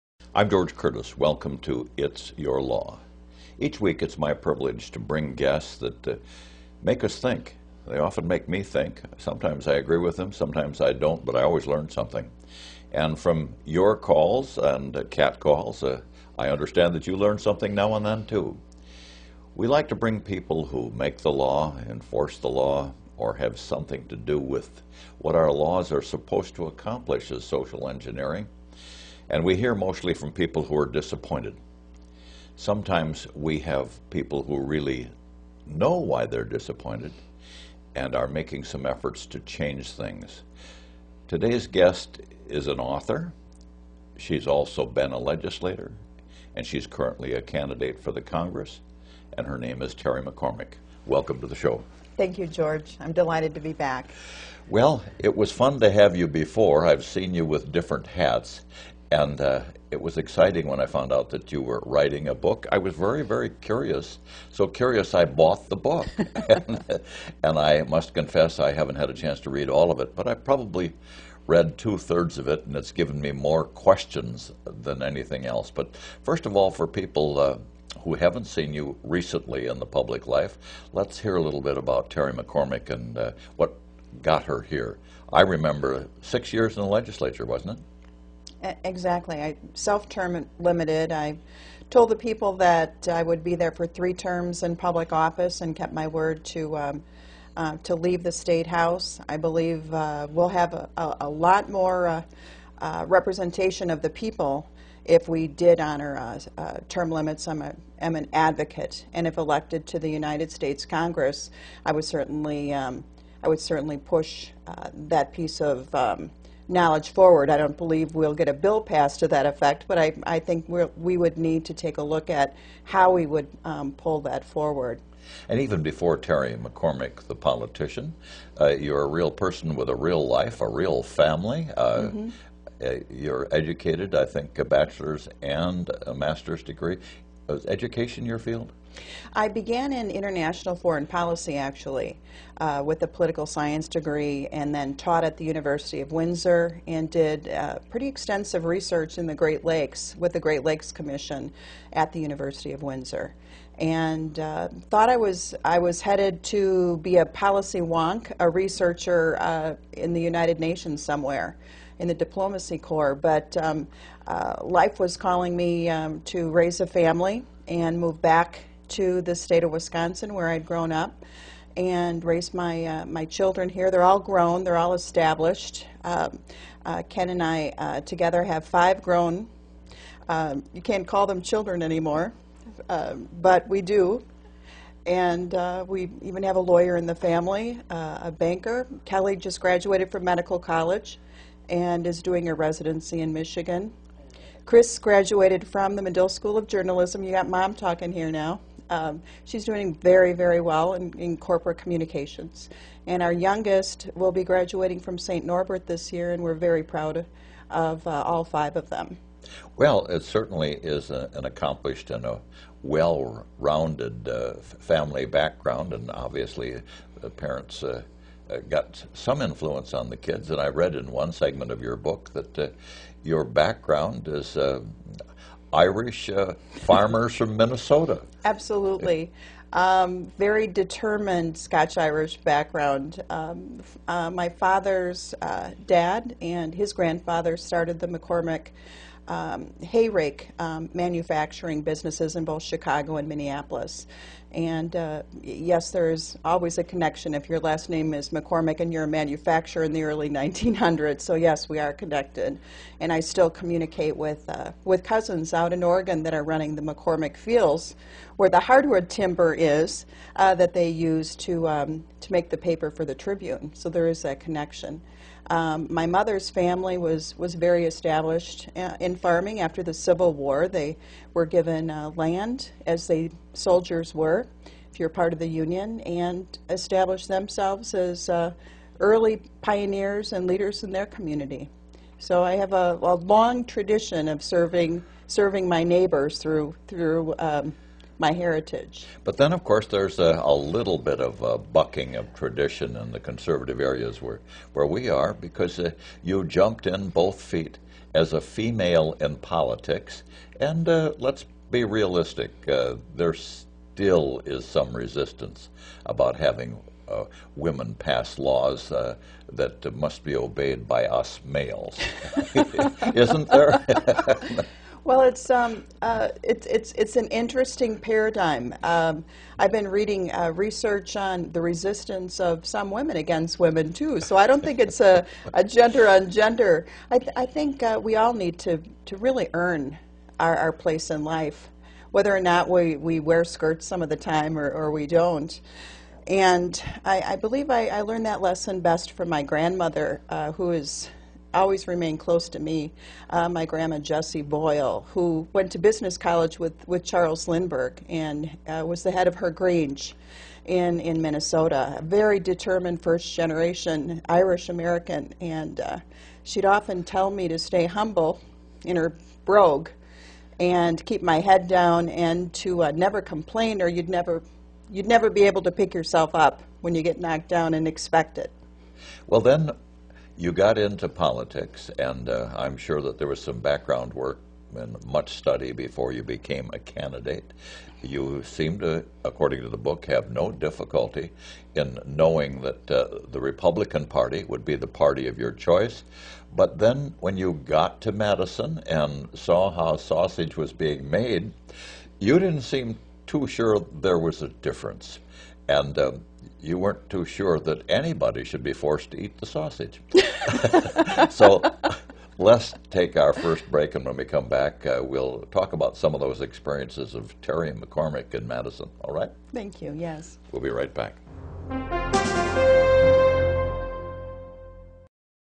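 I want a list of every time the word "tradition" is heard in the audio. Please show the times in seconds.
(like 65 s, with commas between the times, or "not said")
283 s, 292 s.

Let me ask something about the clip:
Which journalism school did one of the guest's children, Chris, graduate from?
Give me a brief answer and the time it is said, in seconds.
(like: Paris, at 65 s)
Medill School of Journalism, at 196 s.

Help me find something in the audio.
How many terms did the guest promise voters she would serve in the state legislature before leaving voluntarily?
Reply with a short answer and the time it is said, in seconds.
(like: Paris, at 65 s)
3, at 93 s.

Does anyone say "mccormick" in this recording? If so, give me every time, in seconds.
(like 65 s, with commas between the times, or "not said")
50 s, 82 s, 126 s, 238 s, 248 s, 256 s, 407 s.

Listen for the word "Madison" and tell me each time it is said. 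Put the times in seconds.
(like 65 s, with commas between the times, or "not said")
388 s, 408 s.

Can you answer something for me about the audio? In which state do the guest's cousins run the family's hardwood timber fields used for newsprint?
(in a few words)
Oregon.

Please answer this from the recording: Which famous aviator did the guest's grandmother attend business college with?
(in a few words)
Charles Lindbergh.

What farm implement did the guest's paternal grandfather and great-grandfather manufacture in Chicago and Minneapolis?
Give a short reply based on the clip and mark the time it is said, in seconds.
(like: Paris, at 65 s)
hay rake, at 239 s.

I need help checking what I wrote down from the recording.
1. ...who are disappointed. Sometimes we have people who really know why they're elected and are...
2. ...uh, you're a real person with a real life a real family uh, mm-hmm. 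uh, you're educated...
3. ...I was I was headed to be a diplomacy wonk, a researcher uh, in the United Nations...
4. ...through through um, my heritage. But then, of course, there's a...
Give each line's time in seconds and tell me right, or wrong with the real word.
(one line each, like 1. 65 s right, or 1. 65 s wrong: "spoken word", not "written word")
1. 30 s wrong: "disappointed", not "elected"
2. 128 s right
3. 155 s wrong: "policy", not "diplomacy"
4. 286 s right.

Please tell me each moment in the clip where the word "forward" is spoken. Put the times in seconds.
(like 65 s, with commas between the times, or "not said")
117 s, 124 s.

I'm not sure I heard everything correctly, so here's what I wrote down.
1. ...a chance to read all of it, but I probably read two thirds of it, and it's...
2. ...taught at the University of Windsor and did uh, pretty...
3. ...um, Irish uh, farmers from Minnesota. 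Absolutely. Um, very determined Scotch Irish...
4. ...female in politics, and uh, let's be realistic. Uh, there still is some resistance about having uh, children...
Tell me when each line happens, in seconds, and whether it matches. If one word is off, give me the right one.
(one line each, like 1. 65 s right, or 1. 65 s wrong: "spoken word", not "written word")
1. 69 s right
2. 144 s right
3. 224 s right
4. 298 s wrong: "women", not "children".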